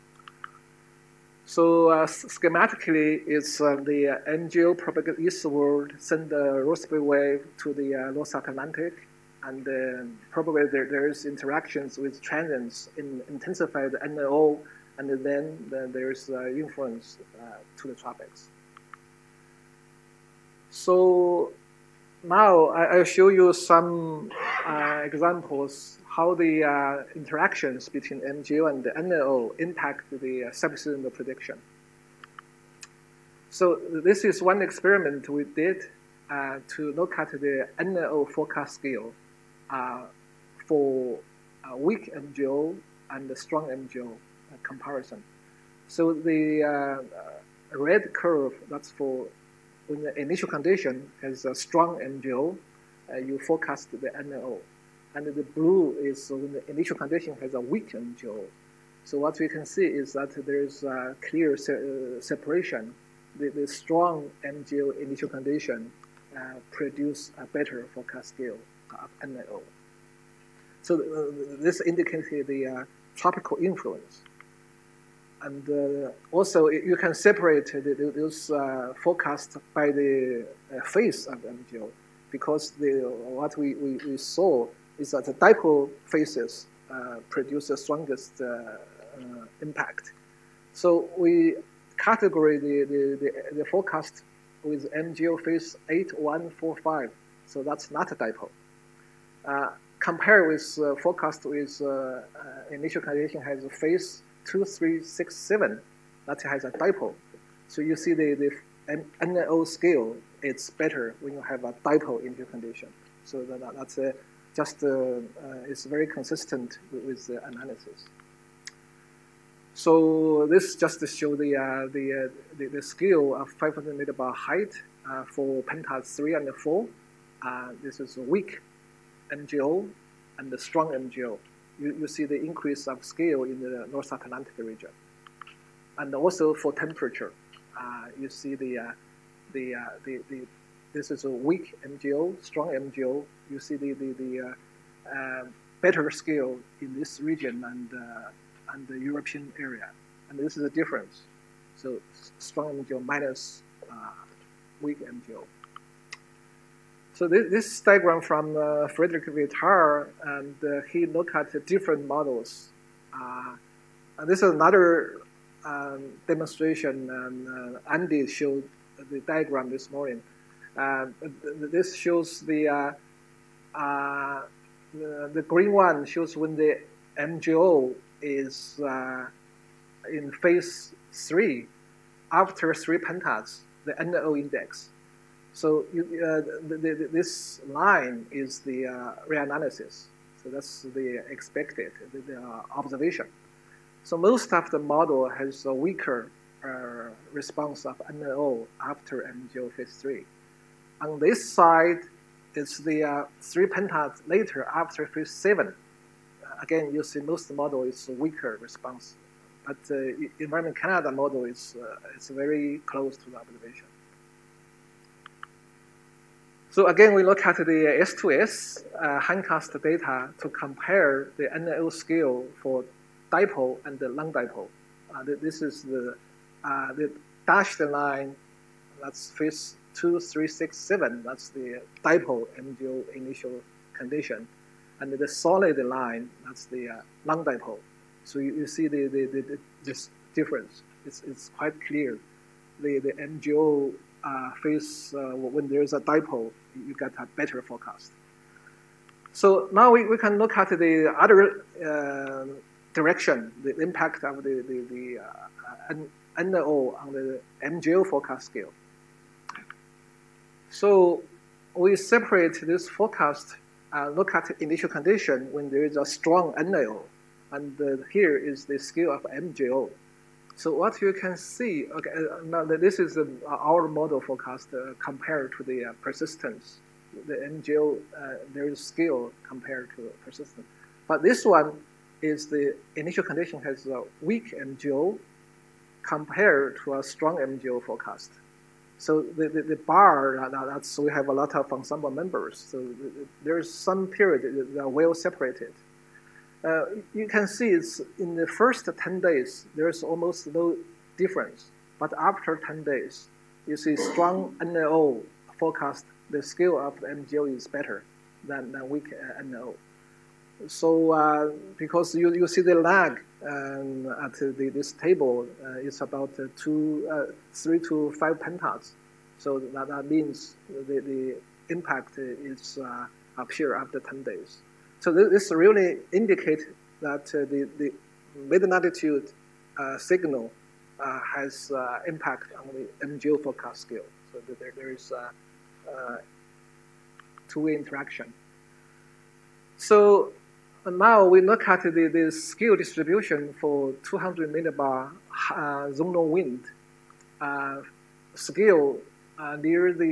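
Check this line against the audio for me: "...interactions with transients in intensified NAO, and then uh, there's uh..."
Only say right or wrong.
right.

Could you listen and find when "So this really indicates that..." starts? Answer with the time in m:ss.
5:25.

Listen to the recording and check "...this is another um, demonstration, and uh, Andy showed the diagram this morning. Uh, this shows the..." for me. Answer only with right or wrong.
right.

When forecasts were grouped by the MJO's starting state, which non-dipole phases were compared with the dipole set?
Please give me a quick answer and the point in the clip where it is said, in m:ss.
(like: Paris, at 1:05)
8, 1, 4, 5, at 1:35.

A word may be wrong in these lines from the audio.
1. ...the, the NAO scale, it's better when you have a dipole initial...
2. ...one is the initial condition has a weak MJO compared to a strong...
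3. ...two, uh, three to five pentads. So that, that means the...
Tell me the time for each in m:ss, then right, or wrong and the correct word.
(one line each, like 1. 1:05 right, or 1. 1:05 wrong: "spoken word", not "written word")
1. 1:48 right
2. 4:41 right
3. 5:16 right.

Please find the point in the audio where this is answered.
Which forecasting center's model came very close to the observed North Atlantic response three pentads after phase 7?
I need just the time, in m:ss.
3:30.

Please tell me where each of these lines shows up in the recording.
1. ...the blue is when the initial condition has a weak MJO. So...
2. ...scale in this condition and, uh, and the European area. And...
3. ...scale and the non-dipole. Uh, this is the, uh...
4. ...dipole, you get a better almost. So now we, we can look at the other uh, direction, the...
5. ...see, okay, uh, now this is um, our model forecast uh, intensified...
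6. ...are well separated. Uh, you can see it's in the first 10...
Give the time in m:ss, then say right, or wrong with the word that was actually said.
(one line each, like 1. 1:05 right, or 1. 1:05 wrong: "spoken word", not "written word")
1. 0:55 right
2. 2:26 wrong: "region", not "condition"
3. 3:43 wrong: "dipole", not "scale"
4. 4:06 wrong: "forecast", not "almost"
5. 4:31 wrong: "compared", not "intensified"
6. 4:54 right.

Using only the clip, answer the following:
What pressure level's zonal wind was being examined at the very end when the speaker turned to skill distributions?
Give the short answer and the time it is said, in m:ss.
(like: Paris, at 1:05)
200 millibar, at 5:44.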